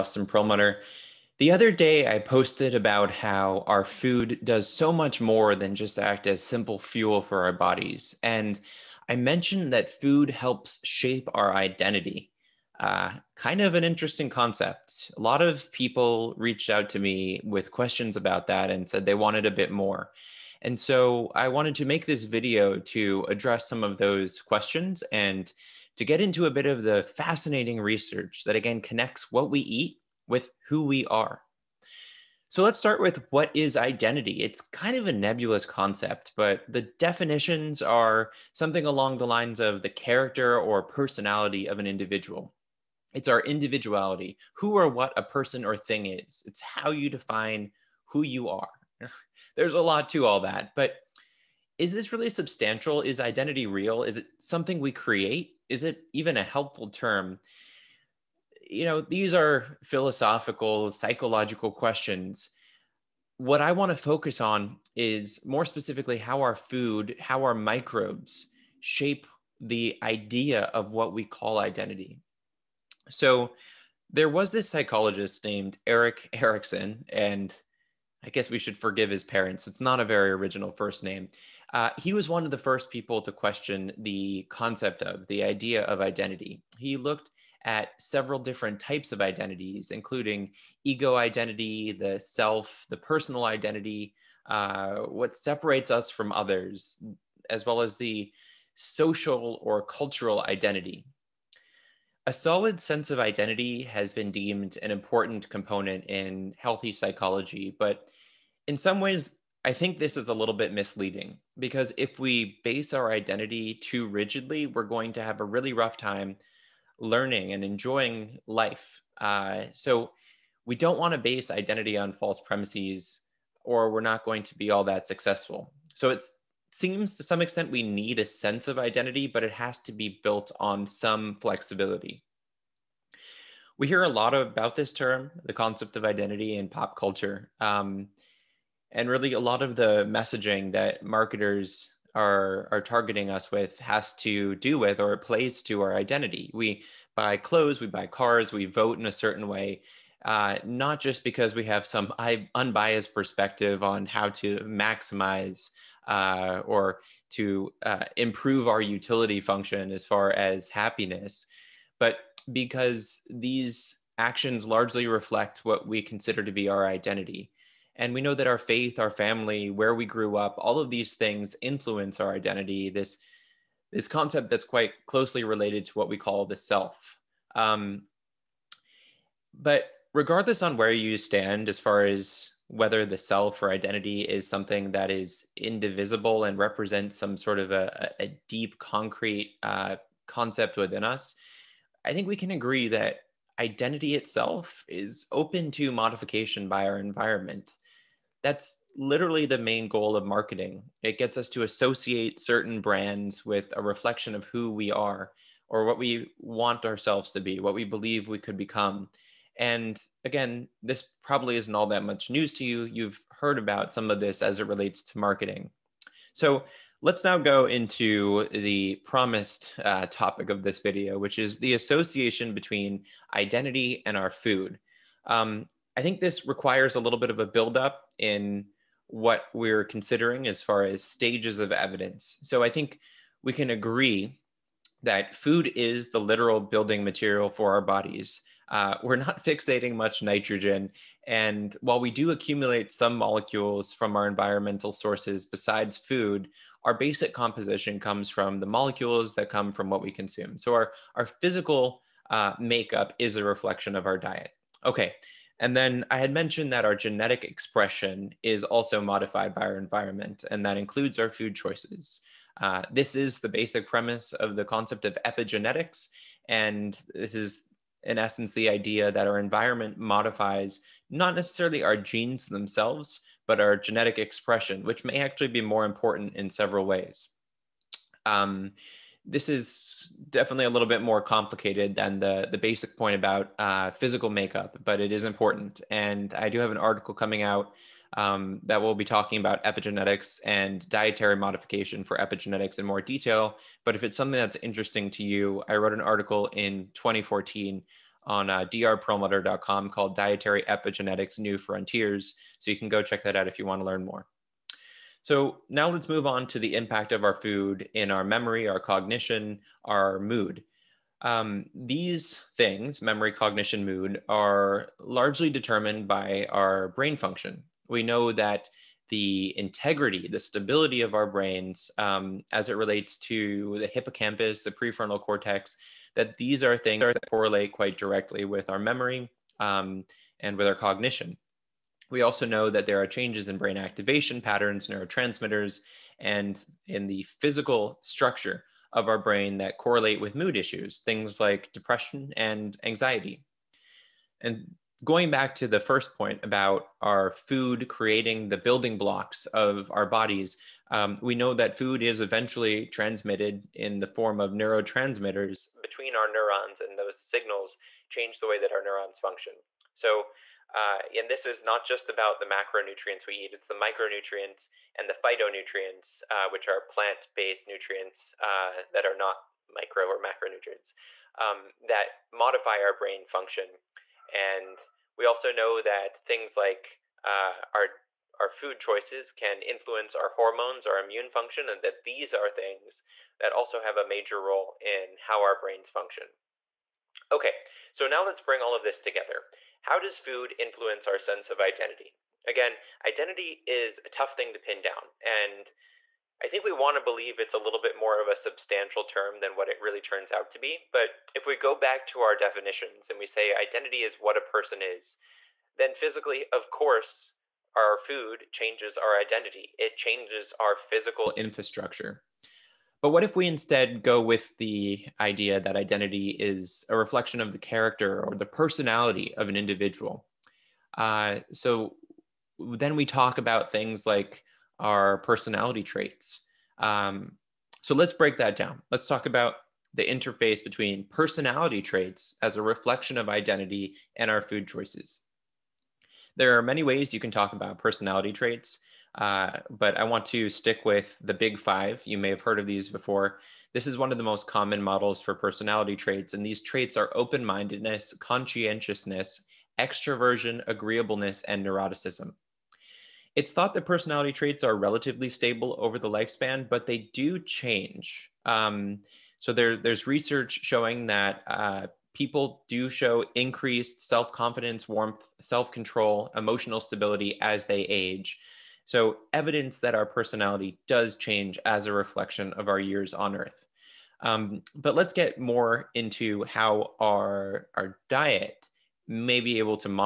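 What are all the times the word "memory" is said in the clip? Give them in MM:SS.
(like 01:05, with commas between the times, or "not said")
05:08, 05:13, 05:28.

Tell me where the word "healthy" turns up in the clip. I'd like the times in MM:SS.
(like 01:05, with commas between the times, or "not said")
01:46.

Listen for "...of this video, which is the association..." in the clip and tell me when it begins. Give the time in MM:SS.
03:40.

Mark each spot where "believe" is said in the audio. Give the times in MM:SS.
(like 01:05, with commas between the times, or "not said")
03:27, 06:37.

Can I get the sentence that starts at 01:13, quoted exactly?
So there was this psychologist named Erik Erikson, and I guess we should forgive his parents.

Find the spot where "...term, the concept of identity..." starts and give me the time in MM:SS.
02:14.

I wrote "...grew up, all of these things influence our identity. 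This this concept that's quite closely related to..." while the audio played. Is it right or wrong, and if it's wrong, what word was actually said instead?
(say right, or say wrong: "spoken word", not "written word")
right.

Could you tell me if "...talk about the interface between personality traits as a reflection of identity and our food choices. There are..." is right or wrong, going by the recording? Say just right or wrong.
right.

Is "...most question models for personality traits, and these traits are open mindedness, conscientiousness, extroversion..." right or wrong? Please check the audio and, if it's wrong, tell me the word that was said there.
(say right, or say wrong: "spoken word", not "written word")
wrong: "common", not "question".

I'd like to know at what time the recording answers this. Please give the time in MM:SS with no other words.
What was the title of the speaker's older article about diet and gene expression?
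05:00.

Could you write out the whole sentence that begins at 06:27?
Okay, so now let's bring all of this together how does food influence our sense of identity?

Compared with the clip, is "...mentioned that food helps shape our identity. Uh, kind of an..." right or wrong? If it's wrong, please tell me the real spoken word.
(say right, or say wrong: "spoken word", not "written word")
right.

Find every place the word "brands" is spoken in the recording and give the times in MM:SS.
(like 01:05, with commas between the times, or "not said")
03:22.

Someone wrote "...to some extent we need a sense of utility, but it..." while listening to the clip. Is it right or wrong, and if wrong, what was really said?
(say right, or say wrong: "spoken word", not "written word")
wrong: "identity", not "utility".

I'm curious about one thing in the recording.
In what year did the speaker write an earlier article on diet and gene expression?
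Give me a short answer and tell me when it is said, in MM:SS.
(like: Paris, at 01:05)
2014, at 04:56.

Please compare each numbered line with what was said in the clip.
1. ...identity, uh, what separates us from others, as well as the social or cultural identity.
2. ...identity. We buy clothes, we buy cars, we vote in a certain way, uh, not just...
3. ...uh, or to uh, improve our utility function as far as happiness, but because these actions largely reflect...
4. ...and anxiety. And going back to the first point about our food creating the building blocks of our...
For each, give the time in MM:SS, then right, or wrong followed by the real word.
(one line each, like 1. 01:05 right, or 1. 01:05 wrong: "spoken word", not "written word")
1. 01:33 right
2. 02:25 right
3. 02:36 right
4. 05:42 right.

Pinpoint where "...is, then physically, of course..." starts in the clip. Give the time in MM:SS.
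06:44.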